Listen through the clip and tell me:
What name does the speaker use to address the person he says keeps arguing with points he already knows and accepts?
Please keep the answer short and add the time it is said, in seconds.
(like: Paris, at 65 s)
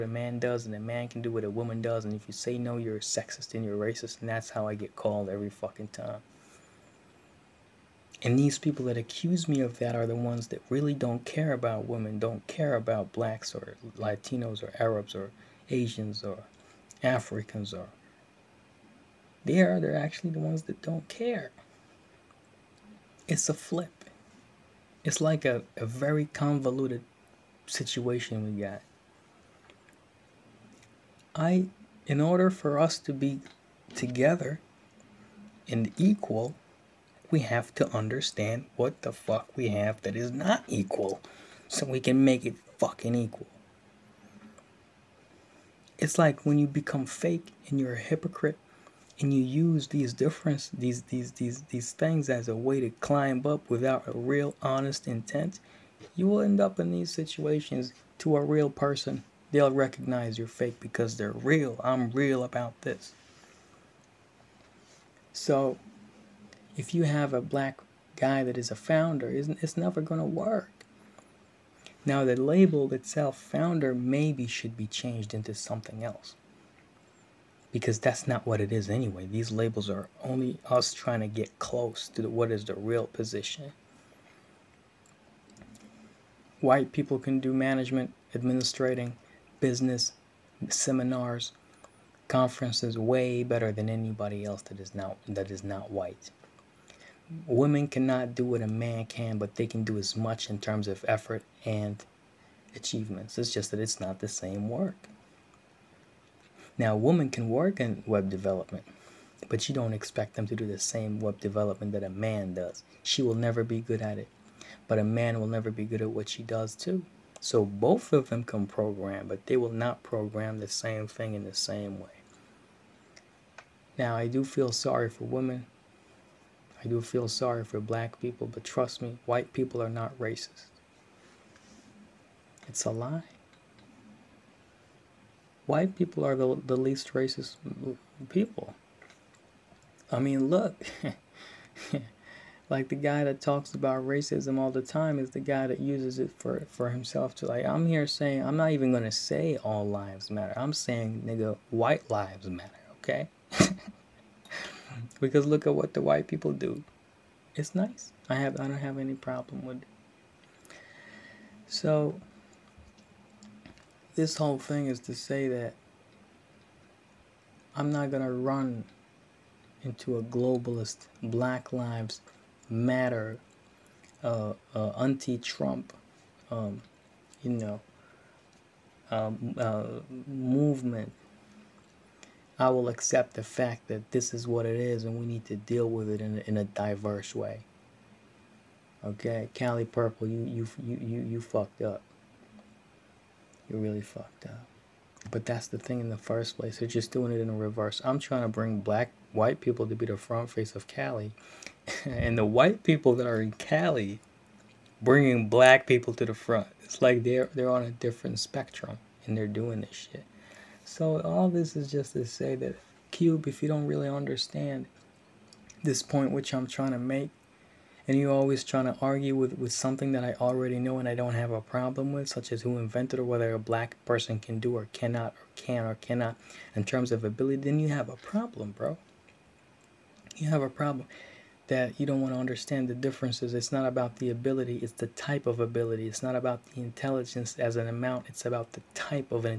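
Cube, at 213 s.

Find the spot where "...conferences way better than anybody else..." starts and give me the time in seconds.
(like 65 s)
92 s.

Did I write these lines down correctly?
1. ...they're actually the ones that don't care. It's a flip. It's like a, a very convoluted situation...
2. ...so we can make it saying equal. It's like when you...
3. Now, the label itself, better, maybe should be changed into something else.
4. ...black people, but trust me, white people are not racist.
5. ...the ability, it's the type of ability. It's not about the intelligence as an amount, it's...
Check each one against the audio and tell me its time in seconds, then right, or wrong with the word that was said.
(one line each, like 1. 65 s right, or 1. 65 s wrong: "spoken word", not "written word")
1. 19 s right
2. 41 s wrong: "fucking", not "saying"
3. 72 s wrong: "founder", not "better"
4. 127 s right
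5. 234 s right.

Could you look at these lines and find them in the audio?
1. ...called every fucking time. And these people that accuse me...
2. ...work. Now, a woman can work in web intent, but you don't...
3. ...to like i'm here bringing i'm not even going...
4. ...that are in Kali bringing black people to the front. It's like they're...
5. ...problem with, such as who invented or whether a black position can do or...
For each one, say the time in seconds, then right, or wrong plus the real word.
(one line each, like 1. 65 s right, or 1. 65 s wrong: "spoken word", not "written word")
1. 4 s right
2. 104 s wrong: "development", not "intent"
3. 147 s wrong: "saying", not "bringing"
4. 203 s right
5. 221 s wrong: "person", not "position".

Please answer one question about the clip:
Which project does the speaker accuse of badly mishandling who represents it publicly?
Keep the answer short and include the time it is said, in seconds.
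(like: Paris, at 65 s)
Kali Purple, at 189 s.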